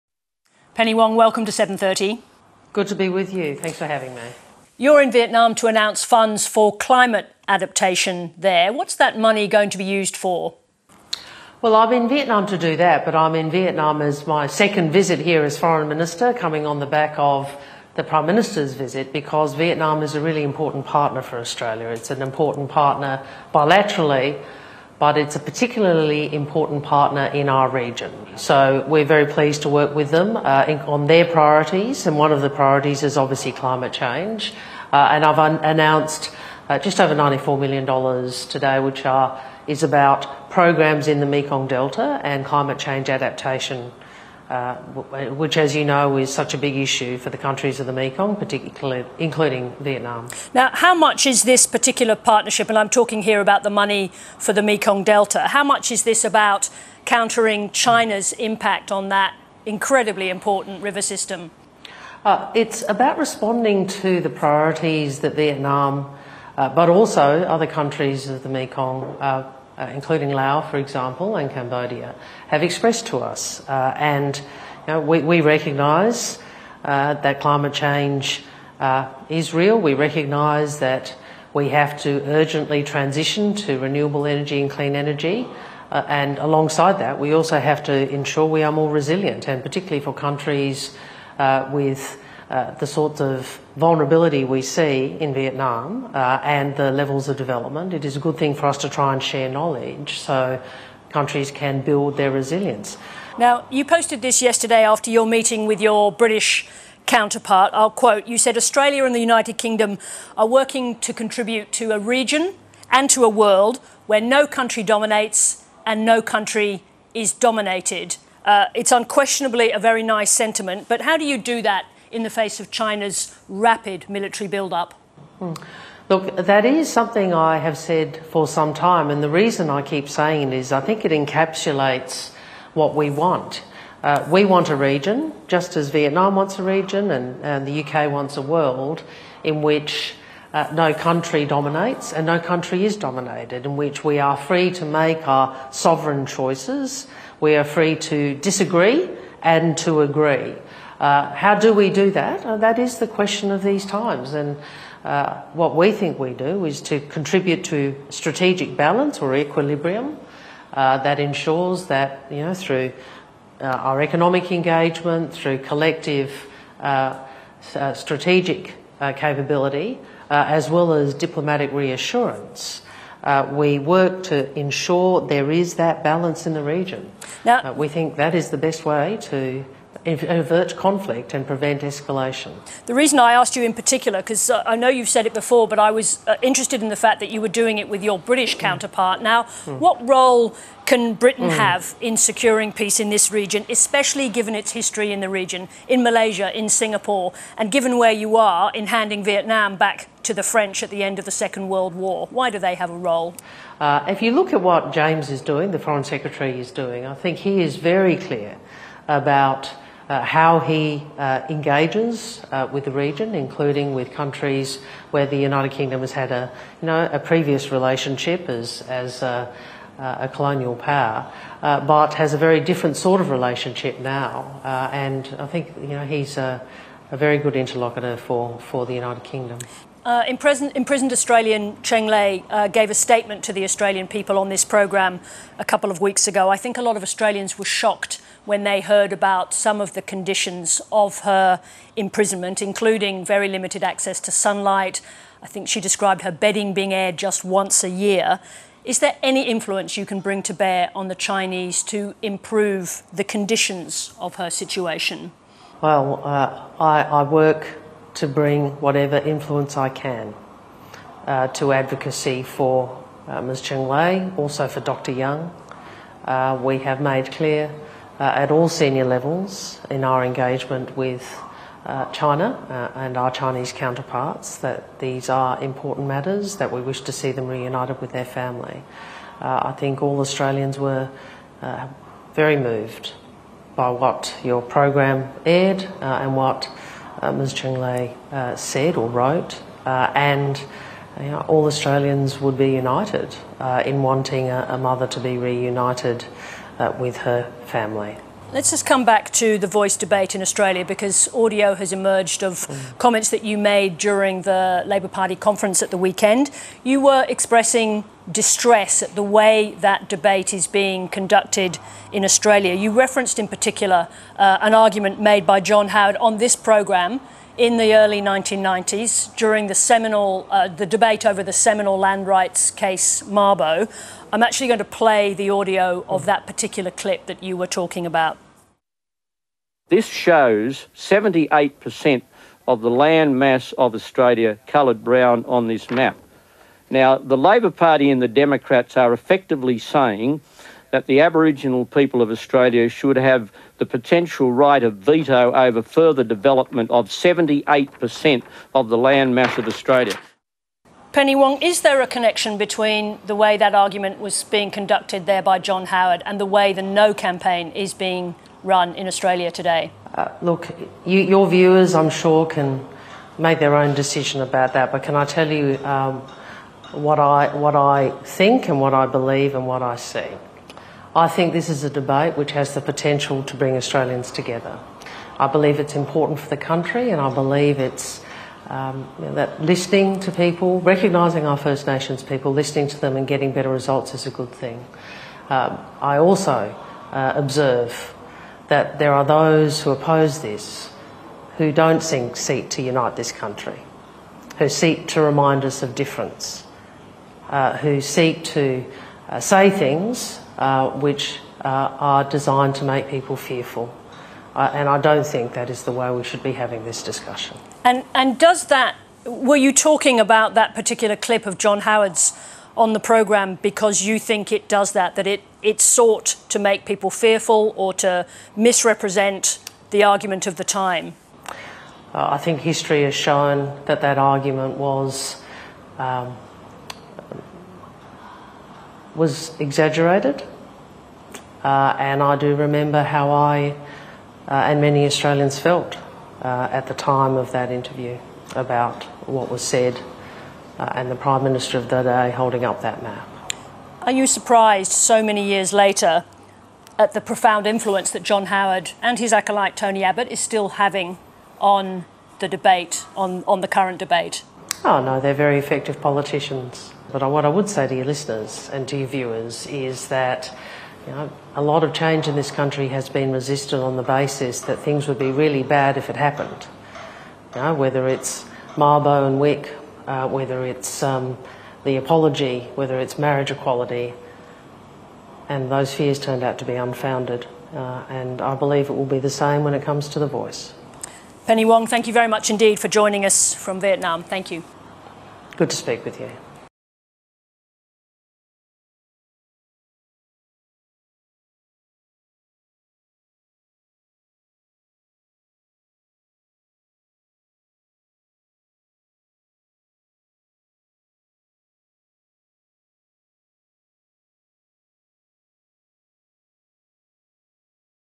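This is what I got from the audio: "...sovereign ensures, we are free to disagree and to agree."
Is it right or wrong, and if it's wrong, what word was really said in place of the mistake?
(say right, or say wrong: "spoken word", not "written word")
wrong: "choices", not "ensures".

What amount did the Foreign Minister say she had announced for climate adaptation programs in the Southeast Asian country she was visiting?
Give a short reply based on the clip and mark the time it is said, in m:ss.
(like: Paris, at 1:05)
$94 million, at 0:37.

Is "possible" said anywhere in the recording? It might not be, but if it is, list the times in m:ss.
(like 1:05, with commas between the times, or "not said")
not said.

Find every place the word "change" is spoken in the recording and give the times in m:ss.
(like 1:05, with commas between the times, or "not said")
0:33, 0:42, 1:17, 7:41.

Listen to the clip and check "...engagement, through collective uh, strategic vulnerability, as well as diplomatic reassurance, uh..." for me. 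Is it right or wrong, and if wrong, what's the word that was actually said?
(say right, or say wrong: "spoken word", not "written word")
wrong: "capability", not "vulnerability".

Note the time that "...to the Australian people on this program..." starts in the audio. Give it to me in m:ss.
3:53.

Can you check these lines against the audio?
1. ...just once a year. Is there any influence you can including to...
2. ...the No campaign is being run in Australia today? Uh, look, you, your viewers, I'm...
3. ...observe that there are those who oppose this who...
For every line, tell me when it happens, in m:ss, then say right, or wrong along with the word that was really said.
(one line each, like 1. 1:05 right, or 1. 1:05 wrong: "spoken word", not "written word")
1. 4:07 wrong: "bring", not "including"
2. 5:56 right
3. 6:27 right.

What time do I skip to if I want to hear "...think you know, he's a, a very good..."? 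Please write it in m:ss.
3:45.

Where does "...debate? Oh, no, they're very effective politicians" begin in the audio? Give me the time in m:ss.
7:33.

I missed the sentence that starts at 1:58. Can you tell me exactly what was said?
Uh, it's unquestionably a very nice sentiment, but how do you do that in the face of China's rapid military build-up?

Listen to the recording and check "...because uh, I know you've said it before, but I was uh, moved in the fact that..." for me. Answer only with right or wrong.
wrong.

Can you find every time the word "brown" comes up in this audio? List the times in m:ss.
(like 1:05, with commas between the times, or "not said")
5:35.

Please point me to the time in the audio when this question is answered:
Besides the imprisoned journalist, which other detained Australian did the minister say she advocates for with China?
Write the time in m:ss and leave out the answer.
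4:24.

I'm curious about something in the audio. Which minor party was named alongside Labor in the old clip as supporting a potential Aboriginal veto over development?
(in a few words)
the Democrats.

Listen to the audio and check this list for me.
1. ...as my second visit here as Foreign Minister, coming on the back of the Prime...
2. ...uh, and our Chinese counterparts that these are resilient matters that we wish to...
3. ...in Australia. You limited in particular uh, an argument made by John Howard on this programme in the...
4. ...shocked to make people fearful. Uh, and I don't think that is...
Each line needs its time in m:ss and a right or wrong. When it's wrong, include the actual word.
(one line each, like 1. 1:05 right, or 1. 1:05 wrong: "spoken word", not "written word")
1. 0:14 right
2. 4:32 wrong: "important", not "resilient"
3. 5:12 wrong: "referenced", not "limited"
4. 6:42 wrong: "designed", not "shocked".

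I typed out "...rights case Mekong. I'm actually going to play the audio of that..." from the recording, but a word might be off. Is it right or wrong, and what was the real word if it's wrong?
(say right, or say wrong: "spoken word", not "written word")
wrong: "Mabo", not "Mekong".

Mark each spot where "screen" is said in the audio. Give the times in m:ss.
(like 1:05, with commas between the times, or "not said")
not said.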